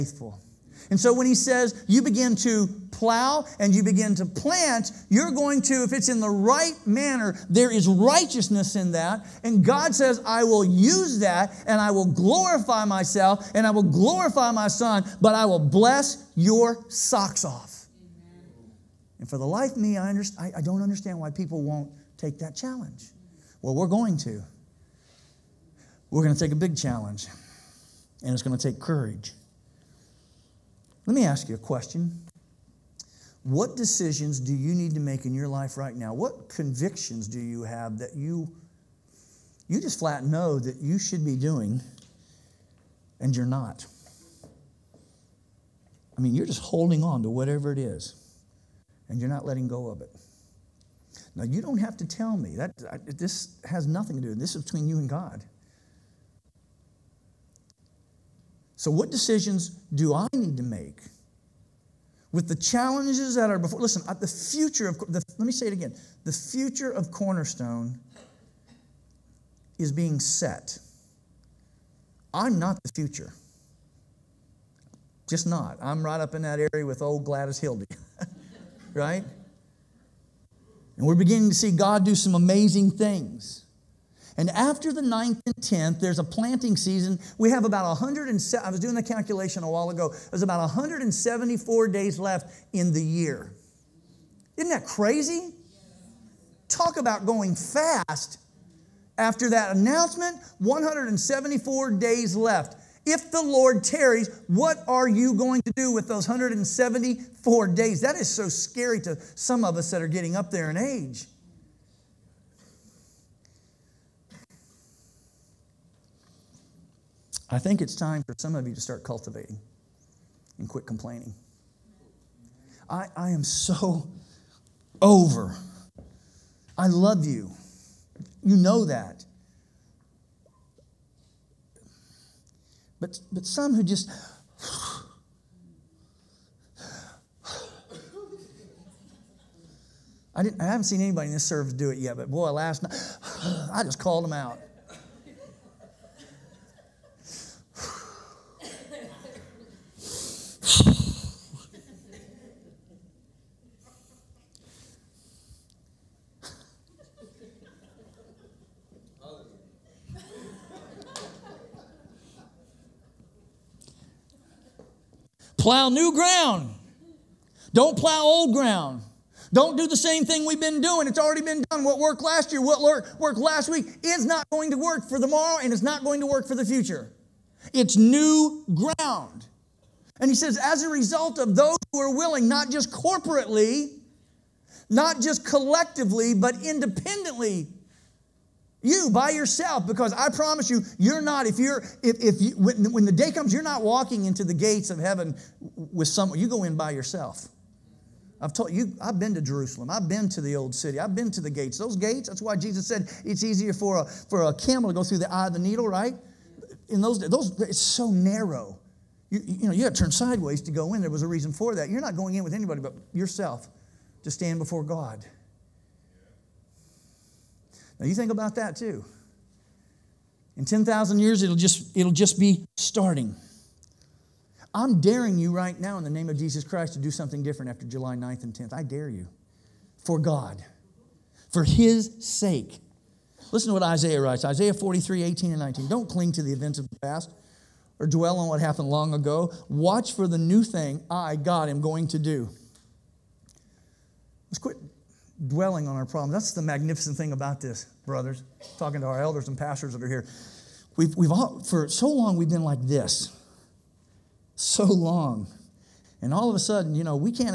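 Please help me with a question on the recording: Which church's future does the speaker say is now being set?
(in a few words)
Cornerstone.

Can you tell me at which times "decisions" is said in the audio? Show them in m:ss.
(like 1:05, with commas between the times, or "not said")
0:33, 0:59.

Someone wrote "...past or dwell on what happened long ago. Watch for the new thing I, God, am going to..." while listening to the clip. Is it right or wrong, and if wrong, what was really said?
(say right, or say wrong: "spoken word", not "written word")
right.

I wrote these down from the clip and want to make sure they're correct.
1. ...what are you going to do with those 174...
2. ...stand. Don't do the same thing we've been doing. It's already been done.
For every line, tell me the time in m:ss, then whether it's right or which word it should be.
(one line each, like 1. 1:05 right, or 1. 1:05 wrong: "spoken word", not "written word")
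1. 1:44 right
2. 2:48 wrong: "ground", not "stand".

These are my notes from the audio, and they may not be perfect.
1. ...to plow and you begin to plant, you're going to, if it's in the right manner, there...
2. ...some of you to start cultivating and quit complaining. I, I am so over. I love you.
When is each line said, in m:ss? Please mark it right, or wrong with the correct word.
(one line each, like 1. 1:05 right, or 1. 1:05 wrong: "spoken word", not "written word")
1. 0:02 right
2. 1:58 right.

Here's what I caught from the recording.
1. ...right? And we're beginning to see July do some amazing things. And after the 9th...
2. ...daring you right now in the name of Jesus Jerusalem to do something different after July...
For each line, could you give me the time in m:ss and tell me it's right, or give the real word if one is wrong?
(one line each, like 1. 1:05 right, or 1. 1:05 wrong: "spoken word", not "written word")
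1. 1:18 wrong: "God", not "July"
2. 3:44 wrong: "Christ", not "Jerusalem".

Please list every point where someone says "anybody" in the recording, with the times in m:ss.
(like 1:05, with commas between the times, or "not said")
2:20, 3:32.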